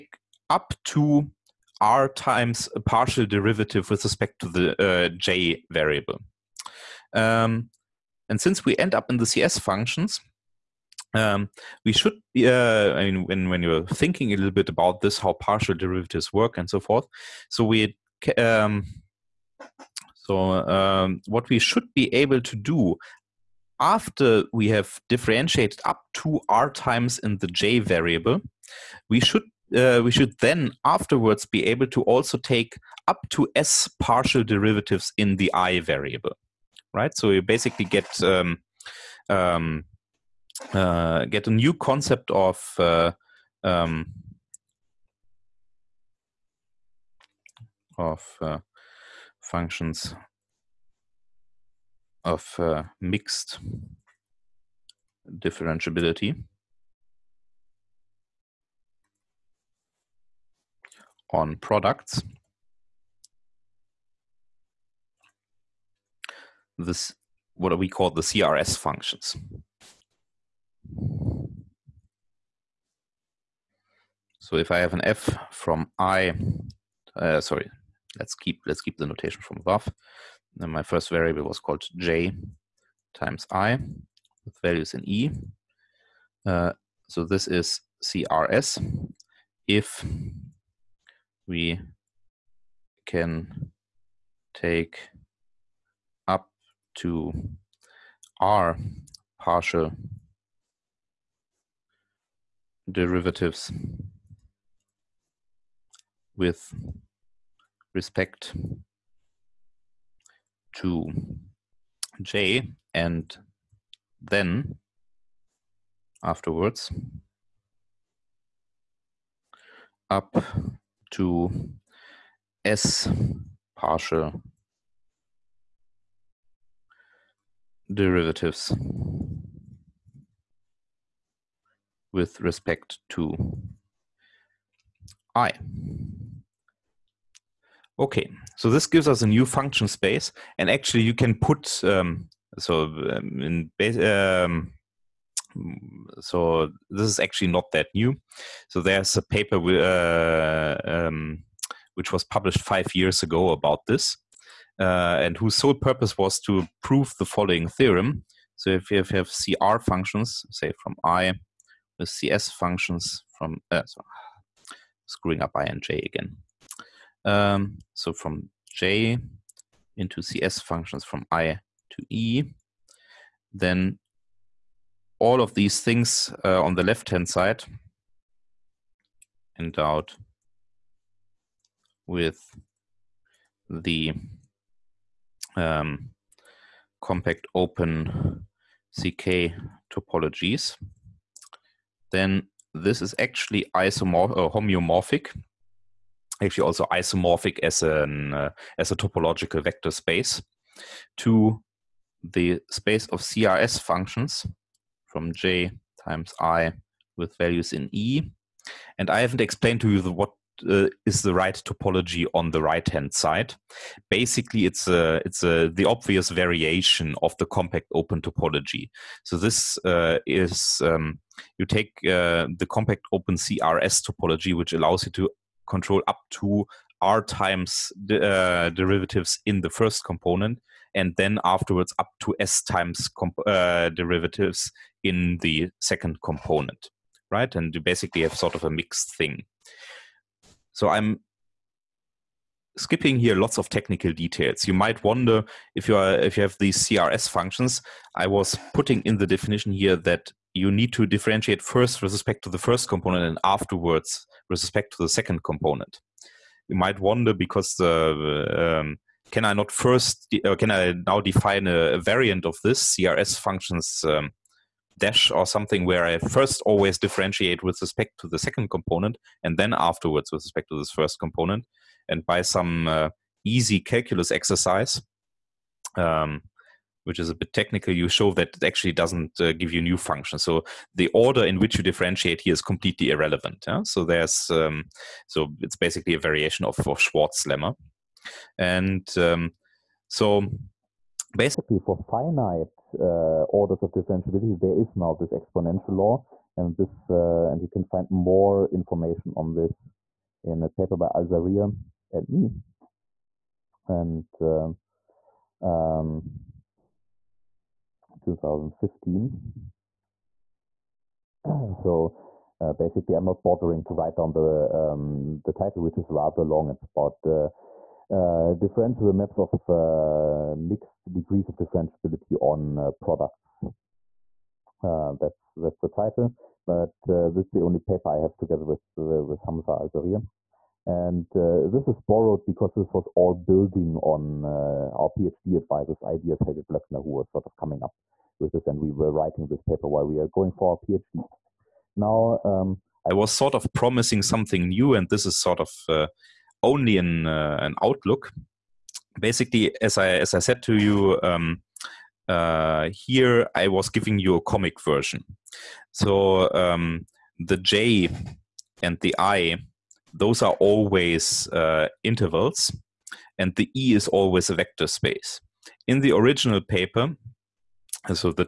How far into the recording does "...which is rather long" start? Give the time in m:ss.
5:15.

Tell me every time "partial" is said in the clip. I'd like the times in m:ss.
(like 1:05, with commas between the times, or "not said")
0:02, 0:15, 0:33, 1:39, 2:03.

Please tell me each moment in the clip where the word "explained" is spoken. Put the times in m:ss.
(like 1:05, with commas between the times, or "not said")
3:29.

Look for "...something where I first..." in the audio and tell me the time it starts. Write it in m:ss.
4:25.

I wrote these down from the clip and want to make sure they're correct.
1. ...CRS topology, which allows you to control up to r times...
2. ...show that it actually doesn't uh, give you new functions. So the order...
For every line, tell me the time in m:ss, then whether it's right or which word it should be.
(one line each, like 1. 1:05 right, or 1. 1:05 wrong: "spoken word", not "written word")
1. 3:43 right
2. 4:38 right.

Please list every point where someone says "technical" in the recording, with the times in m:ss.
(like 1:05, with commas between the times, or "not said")
4:03, 4:37.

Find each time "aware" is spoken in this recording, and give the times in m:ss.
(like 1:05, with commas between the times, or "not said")
not said.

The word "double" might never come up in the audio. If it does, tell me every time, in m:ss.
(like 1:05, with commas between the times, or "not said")
not said.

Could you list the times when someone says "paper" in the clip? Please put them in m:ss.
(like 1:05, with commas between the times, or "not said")
2:29, 5:00, 5:27, 5:39, 6:06.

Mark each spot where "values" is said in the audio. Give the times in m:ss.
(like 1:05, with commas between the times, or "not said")
1:24, 3:27.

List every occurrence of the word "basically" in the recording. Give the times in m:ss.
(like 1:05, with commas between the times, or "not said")
0:37, 3:34, 3:57, 4:45, 4:51, 5:12, 5:49.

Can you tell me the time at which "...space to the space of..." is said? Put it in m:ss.
3:19.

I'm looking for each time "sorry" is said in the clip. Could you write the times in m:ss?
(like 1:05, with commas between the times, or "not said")
1:17, 2:43.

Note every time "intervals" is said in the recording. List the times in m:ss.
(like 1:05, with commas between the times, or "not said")
6:02.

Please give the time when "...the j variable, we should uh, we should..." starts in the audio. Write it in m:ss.
0:27.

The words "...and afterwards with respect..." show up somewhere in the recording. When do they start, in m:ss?
4:13.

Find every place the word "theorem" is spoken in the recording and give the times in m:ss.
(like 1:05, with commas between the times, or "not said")
2:37.